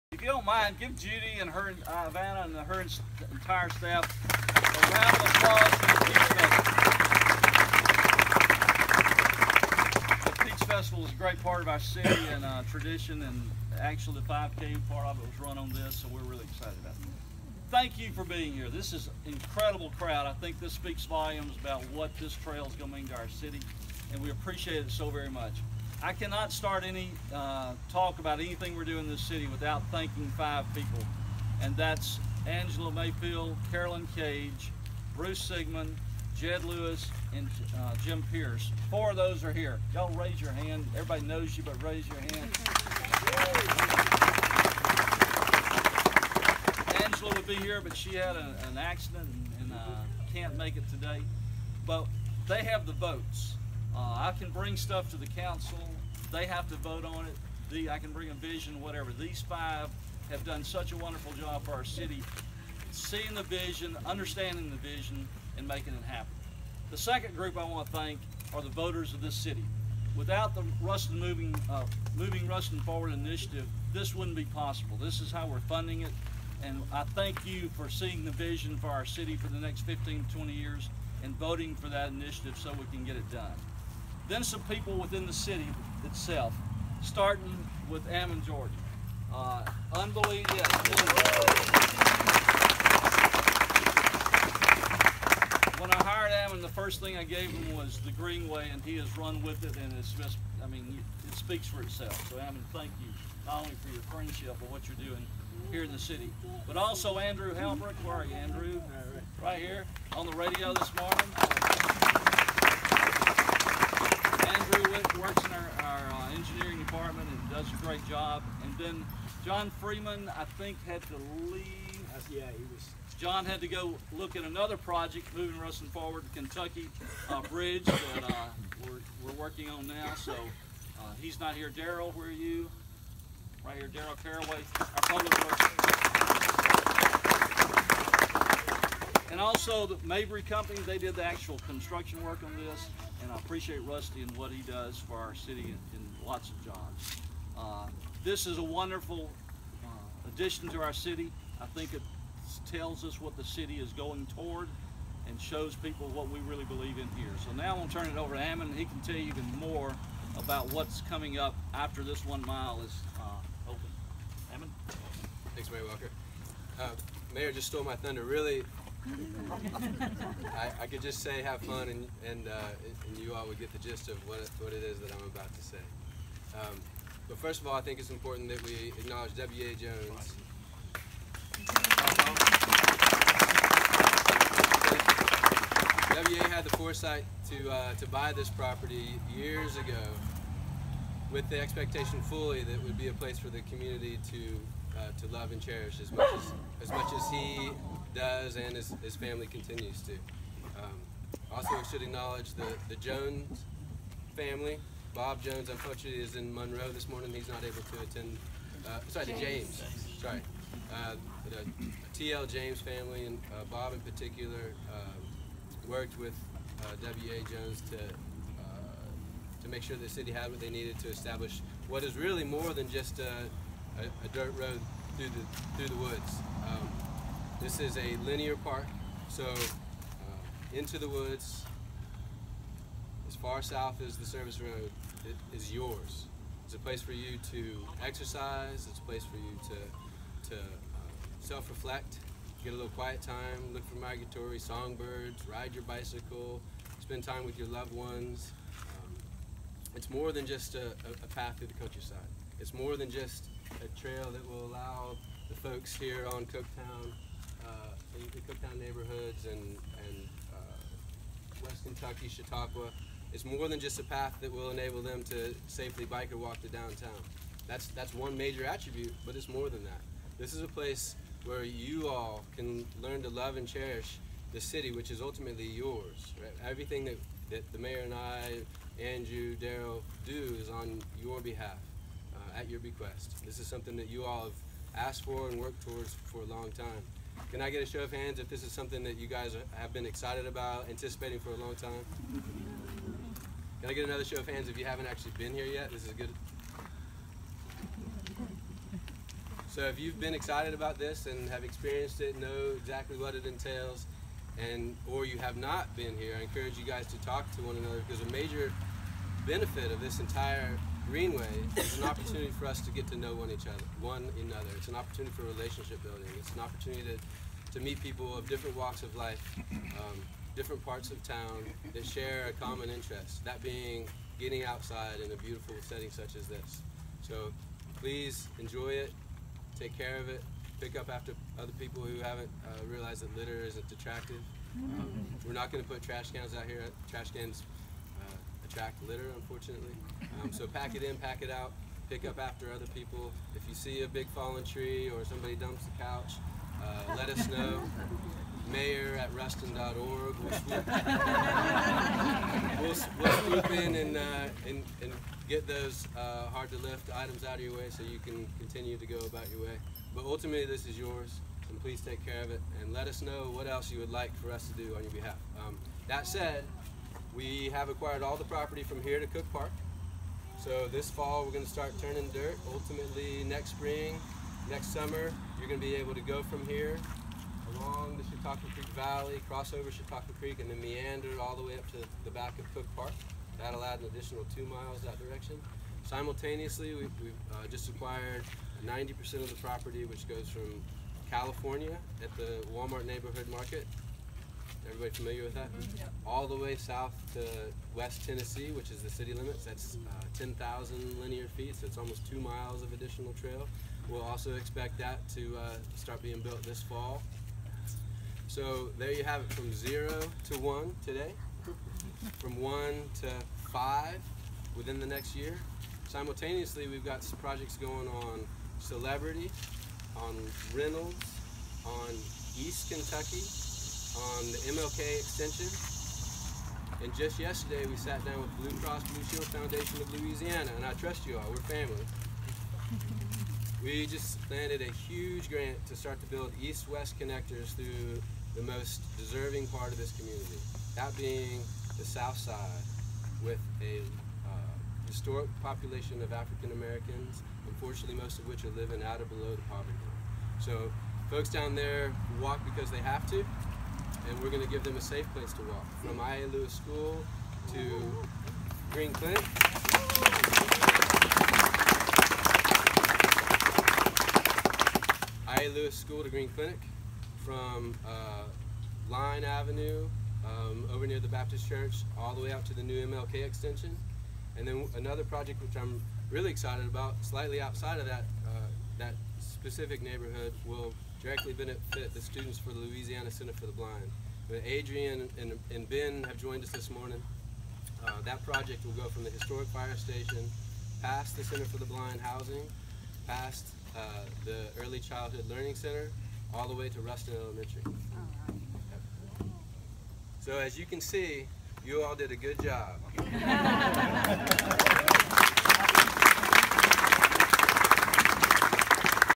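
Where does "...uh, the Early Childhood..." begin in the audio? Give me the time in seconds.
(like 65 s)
493 s.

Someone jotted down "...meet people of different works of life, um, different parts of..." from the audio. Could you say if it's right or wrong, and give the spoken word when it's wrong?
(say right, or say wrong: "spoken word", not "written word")
wrong: "walks", not "works".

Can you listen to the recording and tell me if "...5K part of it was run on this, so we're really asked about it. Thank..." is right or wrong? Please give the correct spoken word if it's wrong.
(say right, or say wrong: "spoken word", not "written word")
wrong: "excited", not "asked".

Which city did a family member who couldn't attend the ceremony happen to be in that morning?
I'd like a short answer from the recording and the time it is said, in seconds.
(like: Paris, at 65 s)
Monroe, at 206 s.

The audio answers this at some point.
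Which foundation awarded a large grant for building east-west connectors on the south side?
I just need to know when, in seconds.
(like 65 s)
428 s.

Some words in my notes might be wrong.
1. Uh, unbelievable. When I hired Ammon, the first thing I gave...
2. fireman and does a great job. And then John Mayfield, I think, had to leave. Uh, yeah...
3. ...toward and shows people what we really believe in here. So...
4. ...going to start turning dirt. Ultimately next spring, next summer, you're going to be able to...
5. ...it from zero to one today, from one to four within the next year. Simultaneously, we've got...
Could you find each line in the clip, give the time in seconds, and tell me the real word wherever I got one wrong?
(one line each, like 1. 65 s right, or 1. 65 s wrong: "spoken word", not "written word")
1. 89 s right
2. 117 s wrong: "Freeman", not "Mayfield"
3. 154 s right
4. 371 s right
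5. 409 s wrong: "five", not "four".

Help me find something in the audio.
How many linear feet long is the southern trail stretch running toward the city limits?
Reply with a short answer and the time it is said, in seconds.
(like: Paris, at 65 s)
10,000, at 400 s.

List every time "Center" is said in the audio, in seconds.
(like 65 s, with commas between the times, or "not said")
483 s, 491 s, 495 s.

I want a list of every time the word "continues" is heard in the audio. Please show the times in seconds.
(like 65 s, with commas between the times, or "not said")
199 s, 358 s.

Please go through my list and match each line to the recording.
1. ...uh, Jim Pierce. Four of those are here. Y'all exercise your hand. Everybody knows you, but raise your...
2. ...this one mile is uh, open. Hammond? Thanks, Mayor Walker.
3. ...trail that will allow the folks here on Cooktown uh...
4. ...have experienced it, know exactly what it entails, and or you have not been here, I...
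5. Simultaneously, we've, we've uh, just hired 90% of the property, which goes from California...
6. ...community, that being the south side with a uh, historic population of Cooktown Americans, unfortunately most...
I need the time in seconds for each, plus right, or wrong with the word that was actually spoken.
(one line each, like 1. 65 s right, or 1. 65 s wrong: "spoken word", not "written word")
1. 37 s wrong: "raise", not "exercise"
2. 162 s right
3. 253 s right
4. 301 s right
5. 386 s wrong: "acquired", not "hired"
6. 440 s wrong: "African", not "Cooktown".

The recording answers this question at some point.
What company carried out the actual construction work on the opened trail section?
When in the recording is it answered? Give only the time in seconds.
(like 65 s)
140 s.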